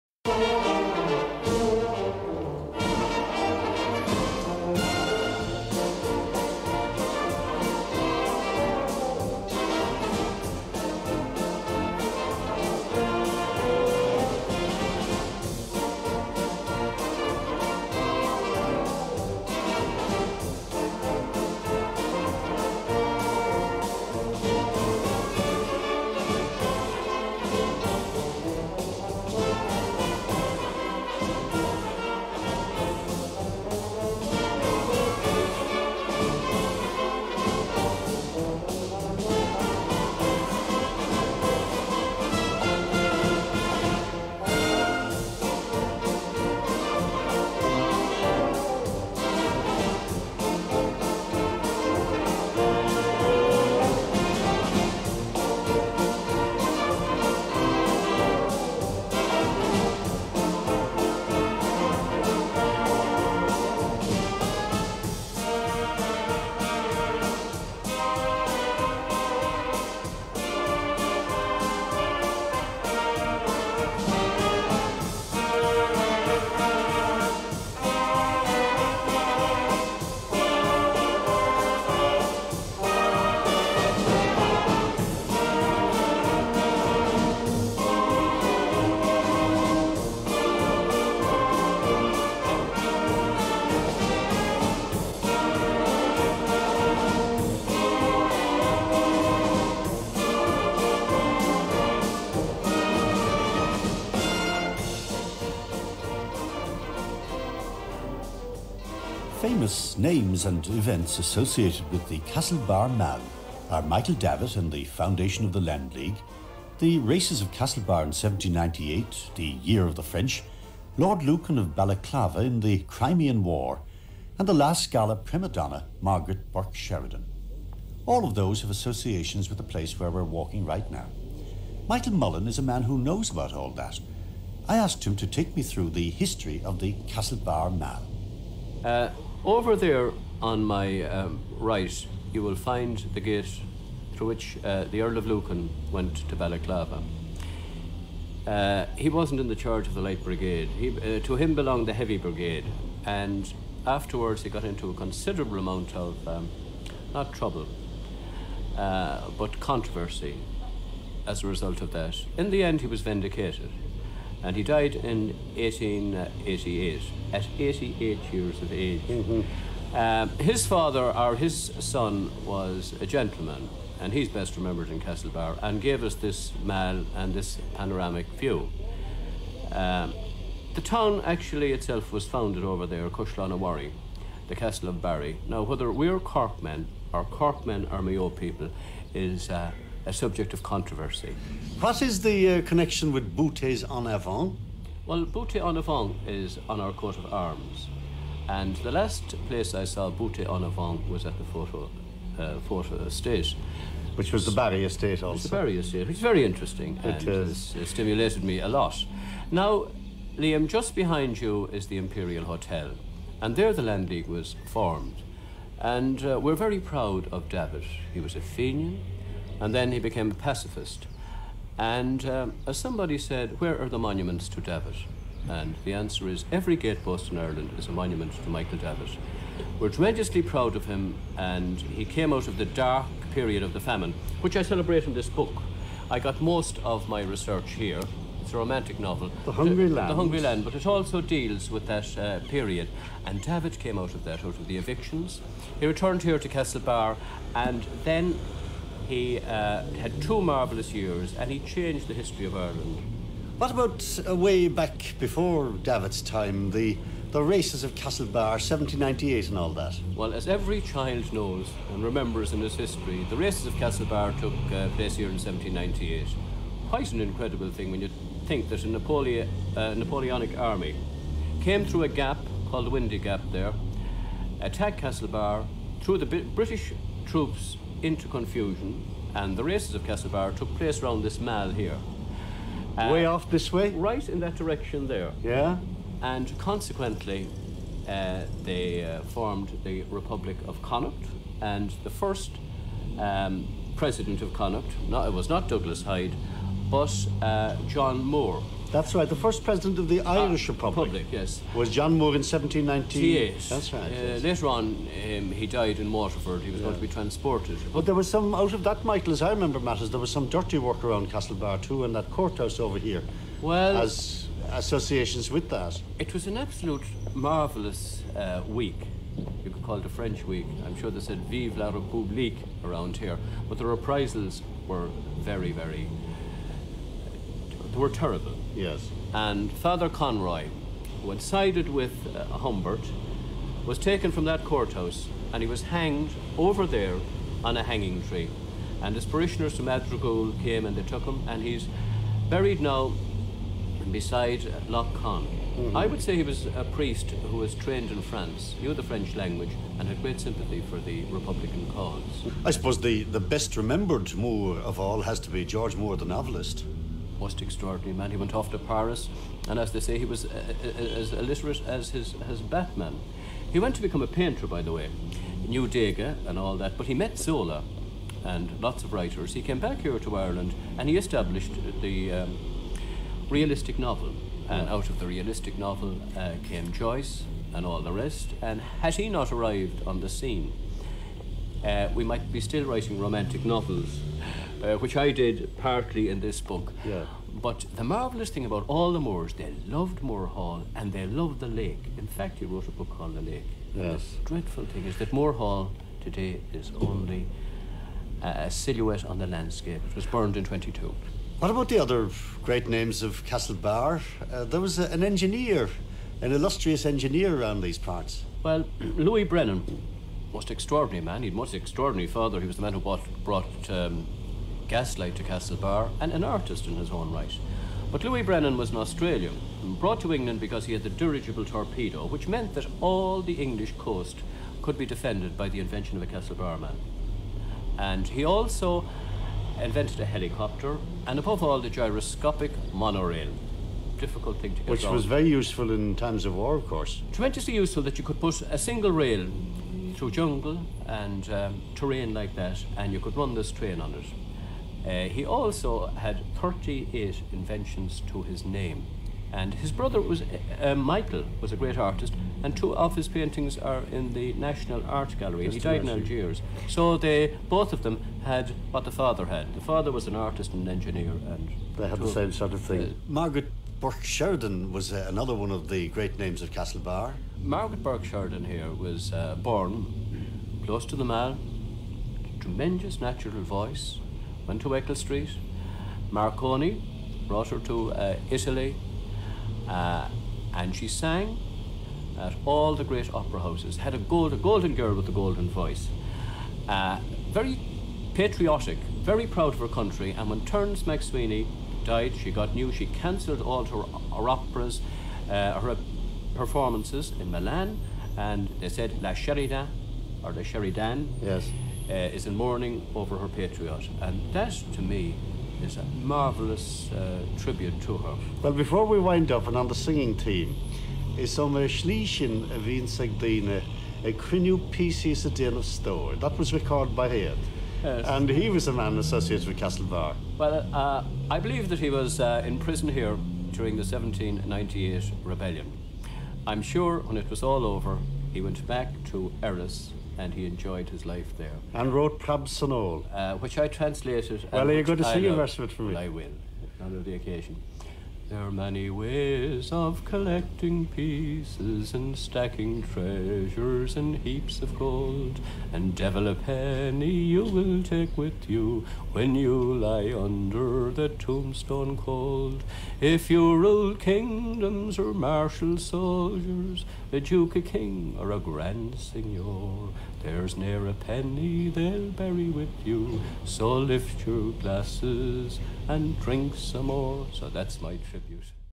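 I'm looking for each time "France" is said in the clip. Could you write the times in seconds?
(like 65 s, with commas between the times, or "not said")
348 s.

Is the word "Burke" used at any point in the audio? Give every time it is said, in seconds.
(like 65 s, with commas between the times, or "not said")
126 s, 463 s, 468 s.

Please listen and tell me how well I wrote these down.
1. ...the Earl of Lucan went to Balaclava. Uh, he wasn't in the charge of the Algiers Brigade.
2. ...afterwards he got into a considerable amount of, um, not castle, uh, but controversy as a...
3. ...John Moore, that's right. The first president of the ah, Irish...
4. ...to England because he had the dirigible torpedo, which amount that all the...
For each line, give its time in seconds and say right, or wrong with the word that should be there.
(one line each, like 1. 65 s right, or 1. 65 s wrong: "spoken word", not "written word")
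1. 144 s wrong: "Light", not "Algiers"
2. 153 s wrong: "trouble", not "castle"
3. 297 s right
4. 420 s wrong: "meant", not "amount".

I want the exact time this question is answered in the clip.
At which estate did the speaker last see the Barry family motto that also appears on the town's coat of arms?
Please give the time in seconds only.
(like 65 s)
201 s.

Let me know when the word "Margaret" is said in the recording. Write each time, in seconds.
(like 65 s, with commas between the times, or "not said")
126 s, 463 s, 467 s.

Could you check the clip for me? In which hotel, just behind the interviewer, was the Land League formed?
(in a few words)
Imperial Hotel.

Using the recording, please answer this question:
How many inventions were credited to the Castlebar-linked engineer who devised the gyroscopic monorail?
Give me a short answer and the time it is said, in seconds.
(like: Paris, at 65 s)
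38, at 446 s.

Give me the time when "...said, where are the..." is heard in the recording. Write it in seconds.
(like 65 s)
223 s.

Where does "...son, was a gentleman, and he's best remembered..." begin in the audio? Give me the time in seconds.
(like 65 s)
171 s.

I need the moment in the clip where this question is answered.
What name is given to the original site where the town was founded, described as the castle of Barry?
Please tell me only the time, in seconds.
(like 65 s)
183 s.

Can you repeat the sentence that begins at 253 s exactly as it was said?
What about uh, way back before Davitt's time, the, the races of Castlebar, 1798 and all that?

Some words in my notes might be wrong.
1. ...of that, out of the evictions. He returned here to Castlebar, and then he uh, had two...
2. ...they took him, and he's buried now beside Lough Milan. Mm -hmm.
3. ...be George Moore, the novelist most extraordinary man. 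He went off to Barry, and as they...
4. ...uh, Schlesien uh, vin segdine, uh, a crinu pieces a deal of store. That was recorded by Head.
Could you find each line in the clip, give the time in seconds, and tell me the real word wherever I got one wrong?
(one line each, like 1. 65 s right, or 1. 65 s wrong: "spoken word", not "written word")
1. 244 s right
2. 340 s wrong: "Conn", not "Milan"
3. 355 s wrong: "Paris", not "Barry"
4. 511 s right.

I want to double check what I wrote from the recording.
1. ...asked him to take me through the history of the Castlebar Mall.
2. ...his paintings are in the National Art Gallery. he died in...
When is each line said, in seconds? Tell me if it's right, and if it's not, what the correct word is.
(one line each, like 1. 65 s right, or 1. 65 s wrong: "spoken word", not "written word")
1. 134 s right
2. 453 s right.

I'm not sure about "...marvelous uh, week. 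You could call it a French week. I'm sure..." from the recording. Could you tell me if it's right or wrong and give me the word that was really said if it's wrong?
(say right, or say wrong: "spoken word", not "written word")
right.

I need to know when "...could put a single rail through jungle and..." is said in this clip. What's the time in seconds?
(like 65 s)
438 s.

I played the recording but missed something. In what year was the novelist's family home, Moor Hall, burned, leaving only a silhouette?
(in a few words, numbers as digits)
1922.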